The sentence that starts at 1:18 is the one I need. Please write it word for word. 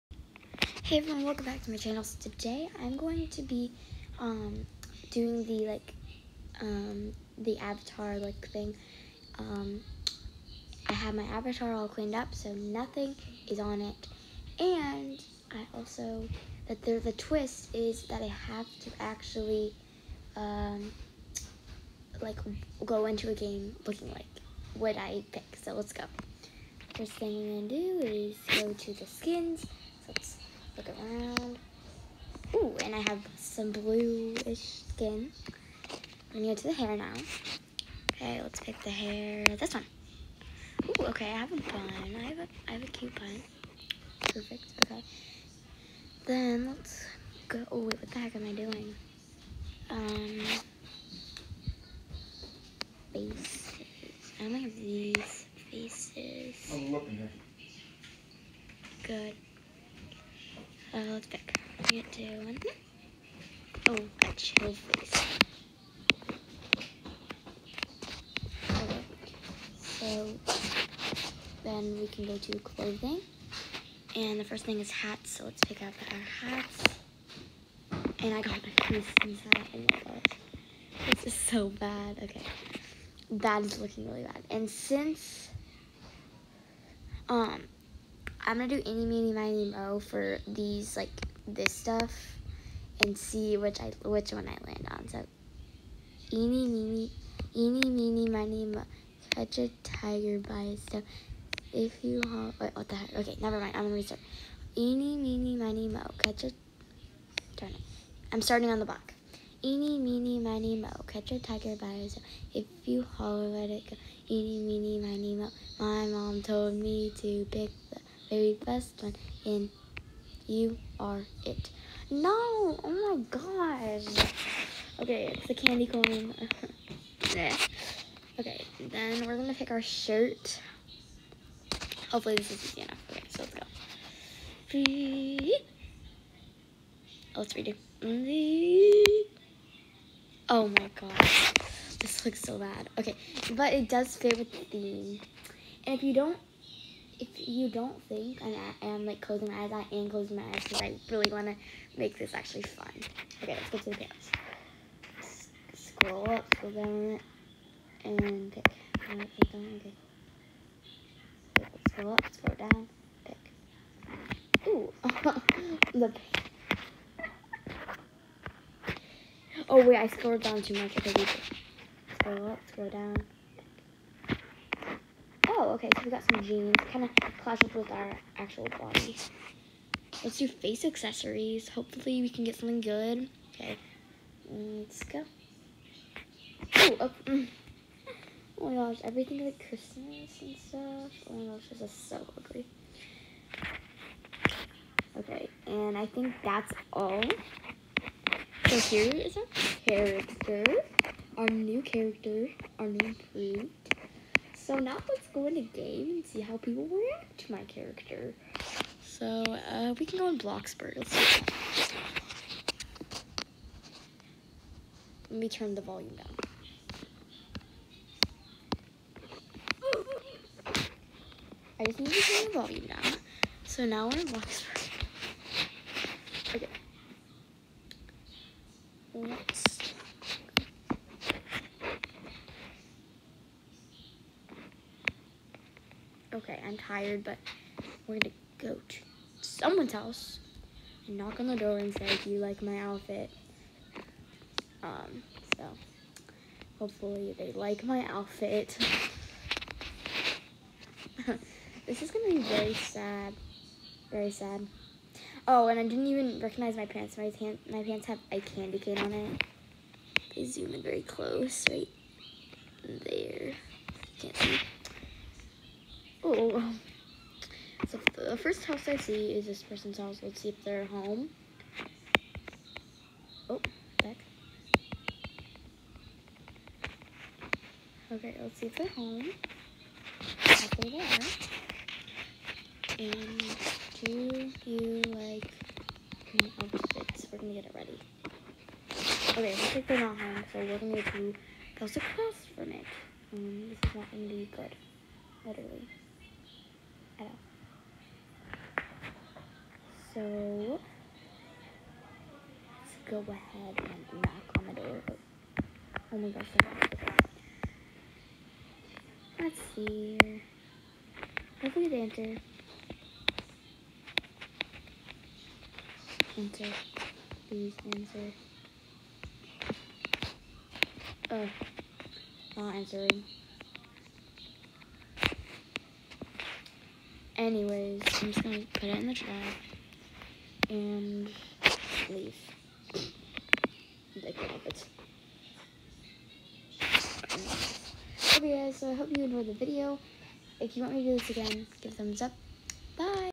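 And I got my Christmas hat, Oh my gosh.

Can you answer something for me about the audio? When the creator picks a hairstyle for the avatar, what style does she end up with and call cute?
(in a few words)
a bun.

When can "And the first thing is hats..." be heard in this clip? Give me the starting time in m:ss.
1:14.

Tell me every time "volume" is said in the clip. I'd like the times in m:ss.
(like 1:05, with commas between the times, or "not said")
3:35, 3:42.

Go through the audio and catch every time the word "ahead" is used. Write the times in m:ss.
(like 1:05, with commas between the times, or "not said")
5:03.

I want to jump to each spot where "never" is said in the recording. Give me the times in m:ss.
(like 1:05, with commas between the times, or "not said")
1:43.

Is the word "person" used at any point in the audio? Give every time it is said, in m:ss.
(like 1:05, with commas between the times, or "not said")
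4:29.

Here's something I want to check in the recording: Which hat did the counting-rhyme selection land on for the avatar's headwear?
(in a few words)
candy corn.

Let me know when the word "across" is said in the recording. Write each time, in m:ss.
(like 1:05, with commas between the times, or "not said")
4:51.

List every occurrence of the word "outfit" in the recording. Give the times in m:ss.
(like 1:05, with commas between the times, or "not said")
4:02, 4:08, 4:46.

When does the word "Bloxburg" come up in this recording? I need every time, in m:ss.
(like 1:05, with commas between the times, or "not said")
3:30, 3:44.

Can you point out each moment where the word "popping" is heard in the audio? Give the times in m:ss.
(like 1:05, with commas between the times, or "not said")
not said.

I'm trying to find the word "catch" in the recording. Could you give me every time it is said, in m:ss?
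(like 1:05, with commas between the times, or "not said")
1:39, 1:46, 1:51.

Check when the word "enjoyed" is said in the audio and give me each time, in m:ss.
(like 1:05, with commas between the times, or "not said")
5:39.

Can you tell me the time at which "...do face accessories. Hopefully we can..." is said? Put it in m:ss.
3:00.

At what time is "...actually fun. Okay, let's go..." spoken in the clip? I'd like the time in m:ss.
2:32.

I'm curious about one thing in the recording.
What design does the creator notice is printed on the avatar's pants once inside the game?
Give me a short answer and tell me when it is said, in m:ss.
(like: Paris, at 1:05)
a candy cane, at 4:18.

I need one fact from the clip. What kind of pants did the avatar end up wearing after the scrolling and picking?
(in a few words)
jeans.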